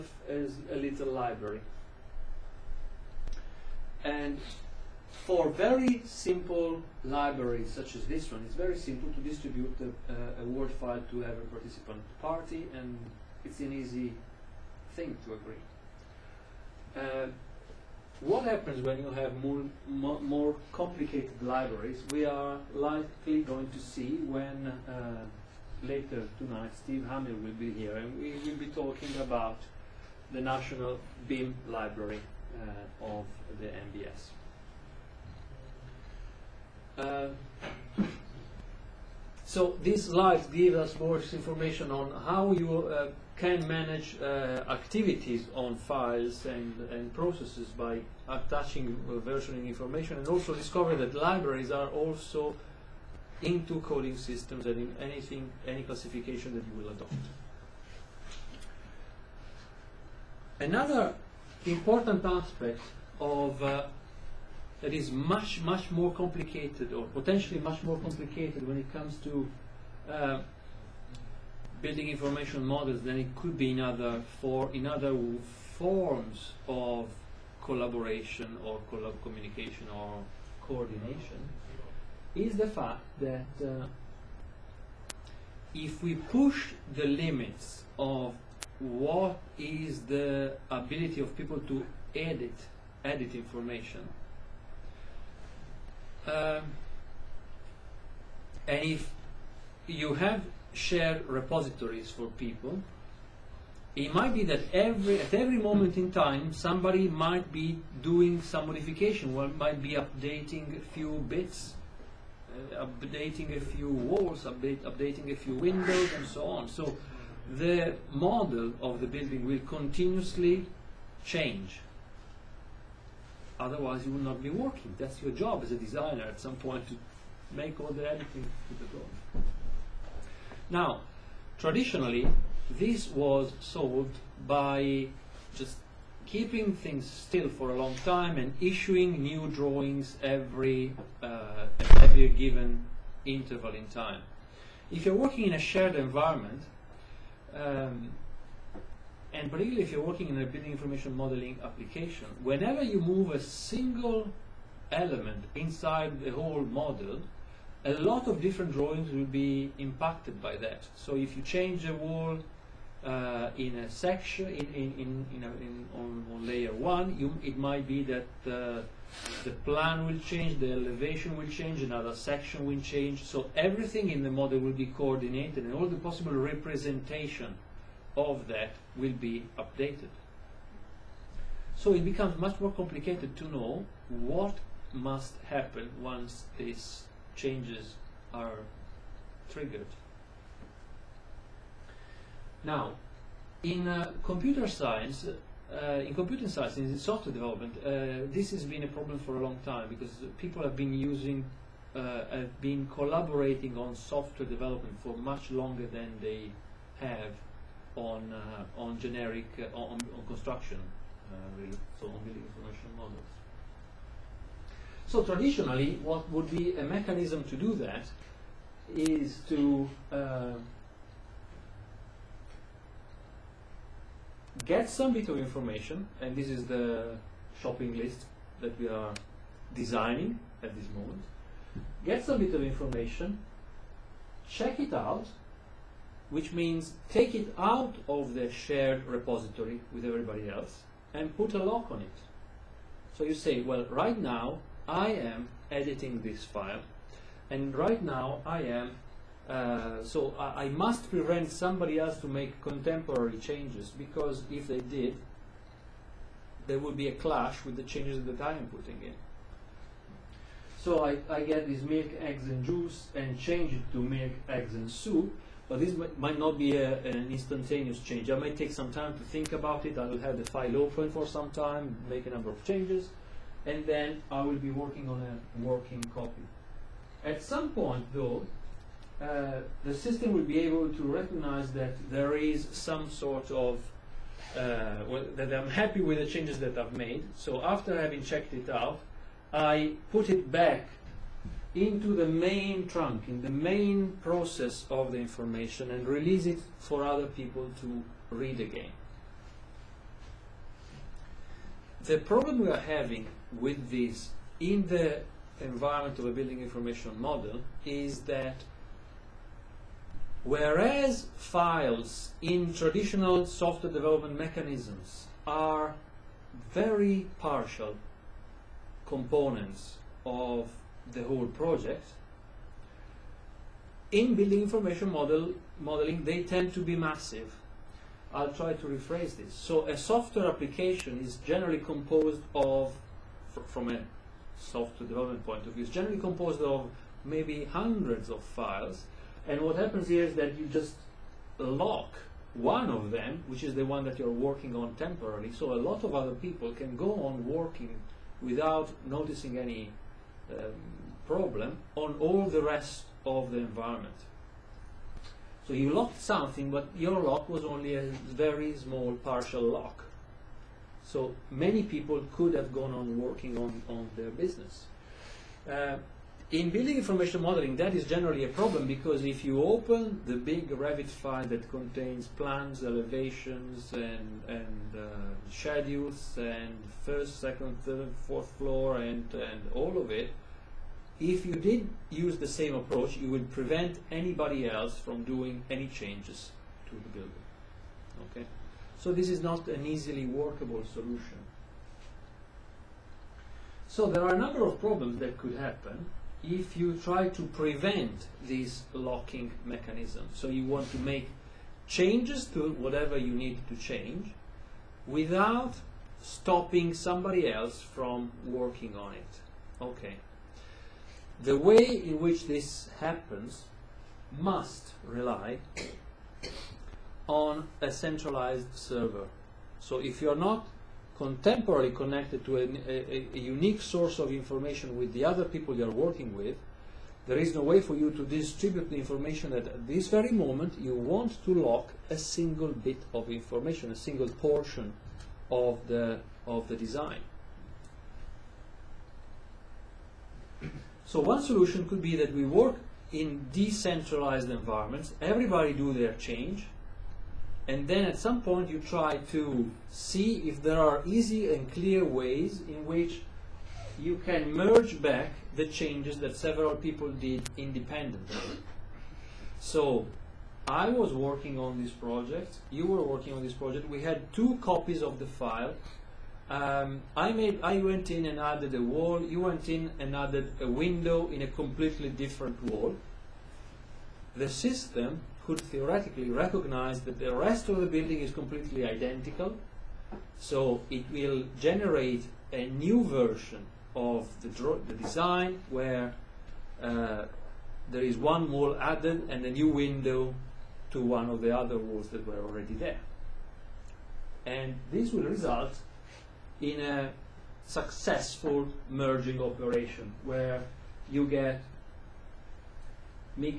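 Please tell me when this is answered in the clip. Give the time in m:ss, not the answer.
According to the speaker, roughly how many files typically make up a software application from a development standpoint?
5:37.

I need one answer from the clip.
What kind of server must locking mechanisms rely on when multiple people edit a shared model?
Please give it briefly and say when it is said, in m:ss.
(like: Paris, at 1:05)
centralized server, at 6:57.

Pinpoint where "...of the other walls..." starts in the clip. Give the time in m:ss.
8:11.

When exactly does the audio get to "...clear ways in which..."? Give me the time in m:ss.
7:31.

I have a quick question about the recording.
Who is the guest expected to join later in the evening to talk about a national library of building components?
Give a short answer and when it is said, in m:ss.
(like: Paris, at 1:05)
Steve Hamil, at 0:26.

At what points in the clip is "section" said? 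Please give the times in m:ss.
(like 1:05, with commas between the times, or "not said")
2:43, 2:52.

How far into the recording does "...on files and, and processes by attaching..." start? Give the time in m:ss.
0:45.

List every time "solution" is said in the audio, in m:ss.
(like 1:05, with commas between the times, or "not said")
6:30, 7:21.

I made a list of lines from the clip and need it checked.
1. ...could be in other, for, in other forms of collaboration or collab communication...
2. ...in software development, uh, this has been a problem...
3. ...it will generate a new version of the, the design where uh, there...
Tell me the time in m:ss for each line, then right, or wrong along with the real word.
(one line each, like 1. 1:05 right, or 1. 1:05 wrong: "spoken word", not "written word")
1. 1:13 right
2. 3:16 right
3. 8:00 right.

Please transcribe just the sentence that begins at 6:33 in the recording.
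So there are a number of problems that could happen if you try to prevent these locking mechanisms.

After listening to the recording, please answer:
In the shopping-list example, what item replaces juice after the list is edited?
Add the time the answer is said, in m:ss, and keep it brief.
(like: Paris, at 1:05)
soup, at 4:23.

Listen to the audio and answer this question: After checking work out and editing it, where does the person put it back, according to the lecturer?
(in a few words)
the main trunk.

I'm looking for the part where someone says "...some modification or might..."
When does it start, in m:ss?
1:48.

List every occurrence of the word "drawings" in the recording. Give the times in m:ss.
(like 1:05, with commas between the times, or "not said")
2:19, 2:38.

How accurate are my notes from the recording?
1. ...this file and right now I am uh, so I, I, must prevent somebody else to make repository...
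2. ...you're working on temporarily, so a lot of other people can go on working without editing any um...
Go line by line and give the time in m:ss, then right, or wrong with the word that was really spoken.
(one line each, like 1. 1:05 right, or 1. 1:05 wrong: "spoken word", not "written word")
1. 4:06 wrong: "contemporary", not "repository"
2. 5:44 wrong: "noticing", not "editing".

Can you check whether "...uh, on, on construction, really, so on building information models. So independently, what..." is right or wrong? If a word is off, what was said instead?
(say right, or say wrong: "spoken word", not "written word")
wrong: "traditionally", not "independently".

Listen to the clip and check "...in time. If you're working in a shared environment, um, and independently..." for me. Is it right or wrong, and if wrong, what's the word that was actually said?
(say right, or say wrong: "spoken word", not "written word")
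wrong: "particularly", not "independently".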